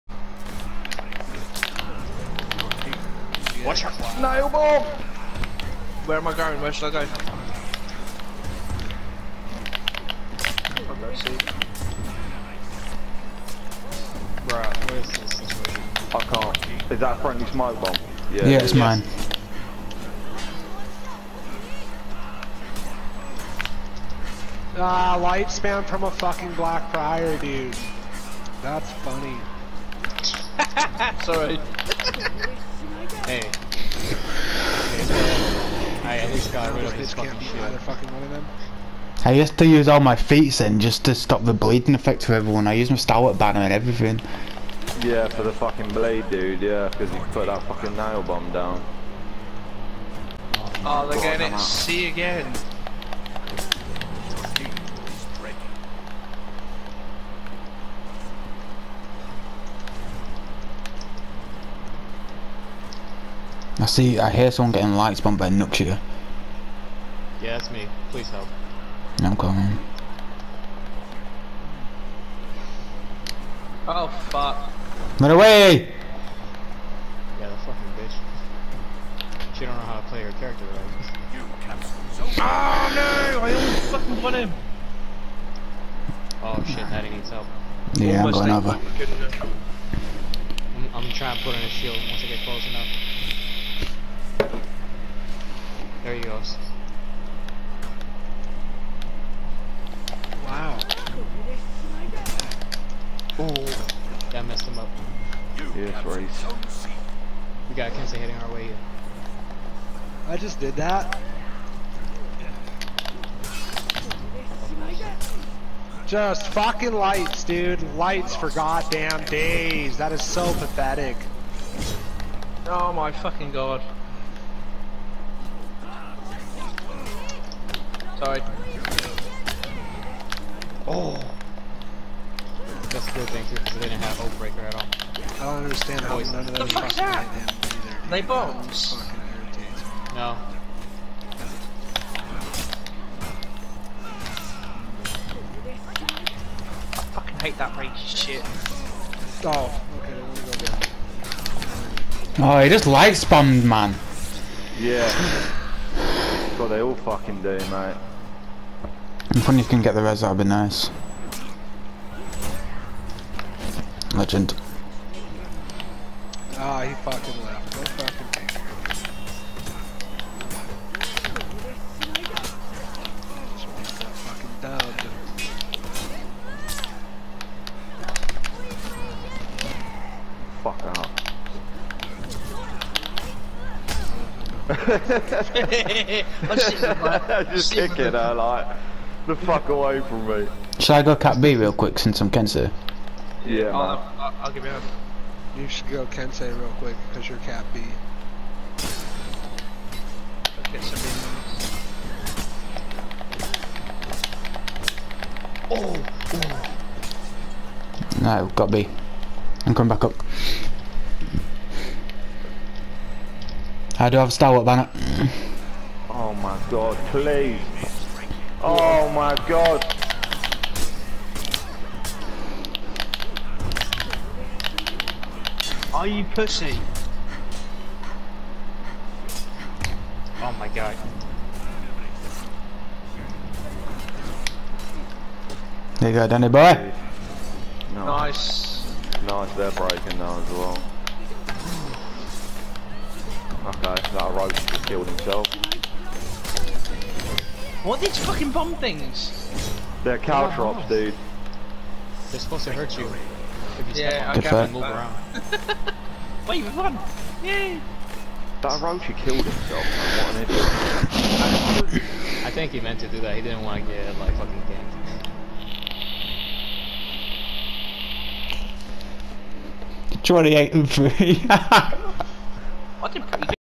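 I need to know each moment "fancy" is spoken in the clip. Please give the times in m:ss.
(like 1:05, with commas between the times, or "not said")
not said.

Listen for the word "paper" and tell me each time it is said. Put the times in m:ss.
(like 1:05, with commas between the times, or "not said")
not said.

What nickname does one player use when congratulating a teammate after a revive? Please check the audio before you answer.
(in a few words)
Danny boy.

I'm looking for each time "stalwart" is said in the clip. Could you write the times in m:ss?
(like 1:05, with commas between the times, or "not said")
0:42, 3:34.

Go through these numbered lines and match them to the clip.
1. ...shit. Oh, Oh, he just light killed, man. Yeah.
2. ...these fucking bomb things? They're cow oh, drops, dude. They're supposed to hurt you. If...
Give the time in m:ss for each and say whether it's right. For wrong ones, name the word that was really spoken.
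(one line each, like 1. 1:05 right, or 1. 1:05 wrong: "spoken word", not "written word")
1. 2:28 wrong: "spammed", not "killed"
2. 4:08 right.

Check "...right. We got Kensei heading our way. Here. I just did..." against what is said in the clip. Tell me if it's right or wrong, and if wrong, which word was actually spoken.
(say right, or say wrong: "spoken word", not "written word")
right.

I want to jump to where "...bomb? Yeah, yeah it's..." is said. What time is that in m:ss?
0:17.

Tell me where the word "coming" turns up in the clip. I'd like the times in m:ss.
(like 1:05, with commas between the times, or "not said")
1:09, 3:29.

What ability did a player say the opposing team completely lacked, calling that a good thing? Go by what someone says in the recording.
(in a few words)
Oak Breaker.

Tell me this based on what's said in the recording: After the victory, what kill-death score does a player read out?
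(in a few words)
28 and 3.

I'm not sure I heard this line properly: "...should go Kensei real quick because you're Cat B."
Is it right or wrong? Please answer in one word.
right.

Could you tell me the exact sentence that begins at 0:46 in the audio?
Yeah, because you put that fucking nail bomb down.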